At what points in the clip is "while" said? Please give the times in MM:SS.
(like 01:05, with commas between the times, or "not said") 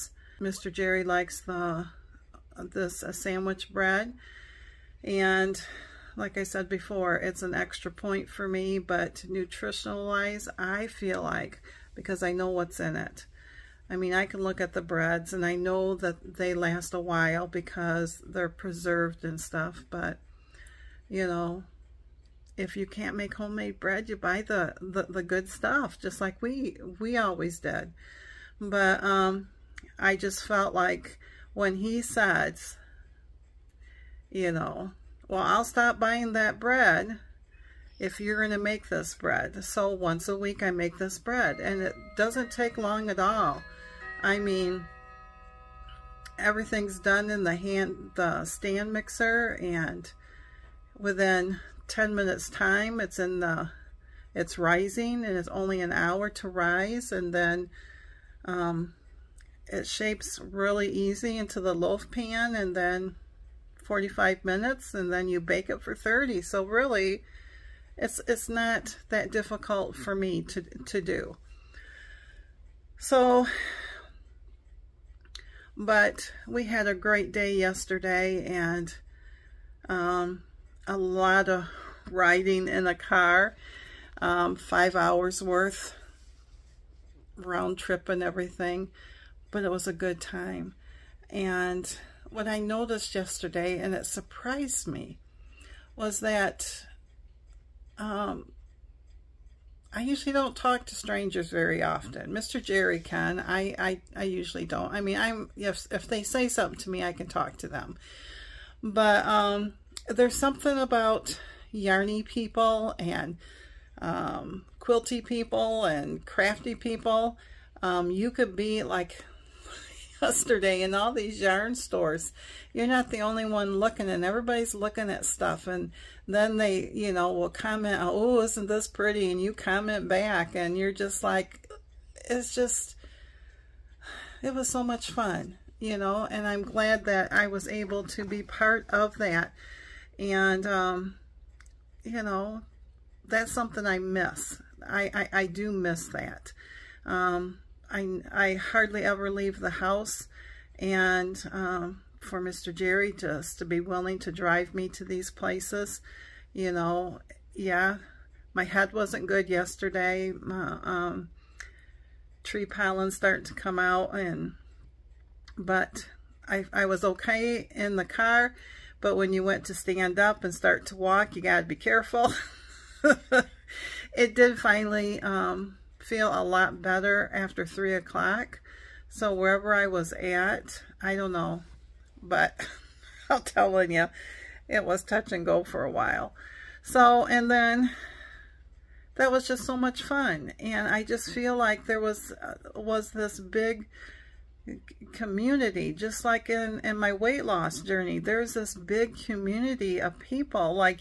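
00:17, 03:05.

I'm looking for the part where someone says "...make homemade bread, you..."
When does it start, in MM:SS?
00:23.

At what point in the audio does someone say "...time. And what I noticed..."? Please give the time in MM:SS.
01:30.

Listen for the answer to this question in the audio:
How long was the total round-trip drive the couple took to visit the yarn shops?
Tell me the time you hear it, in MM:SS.
01:24.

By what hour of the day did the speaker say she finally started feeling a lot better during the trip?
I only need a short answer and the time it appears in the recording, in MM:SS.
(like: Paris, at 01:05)
3 o'clock, at 02:57.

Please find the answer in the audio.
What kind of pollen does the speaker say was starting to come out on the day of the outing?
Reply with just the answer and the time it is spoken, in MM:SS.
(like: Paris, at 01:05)
Tree pollen, at 02:42.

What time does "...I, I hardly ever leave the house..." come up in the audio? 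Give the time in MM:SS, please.
02:27.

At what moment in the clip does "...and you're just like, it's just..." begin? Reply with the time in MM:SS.
02:10.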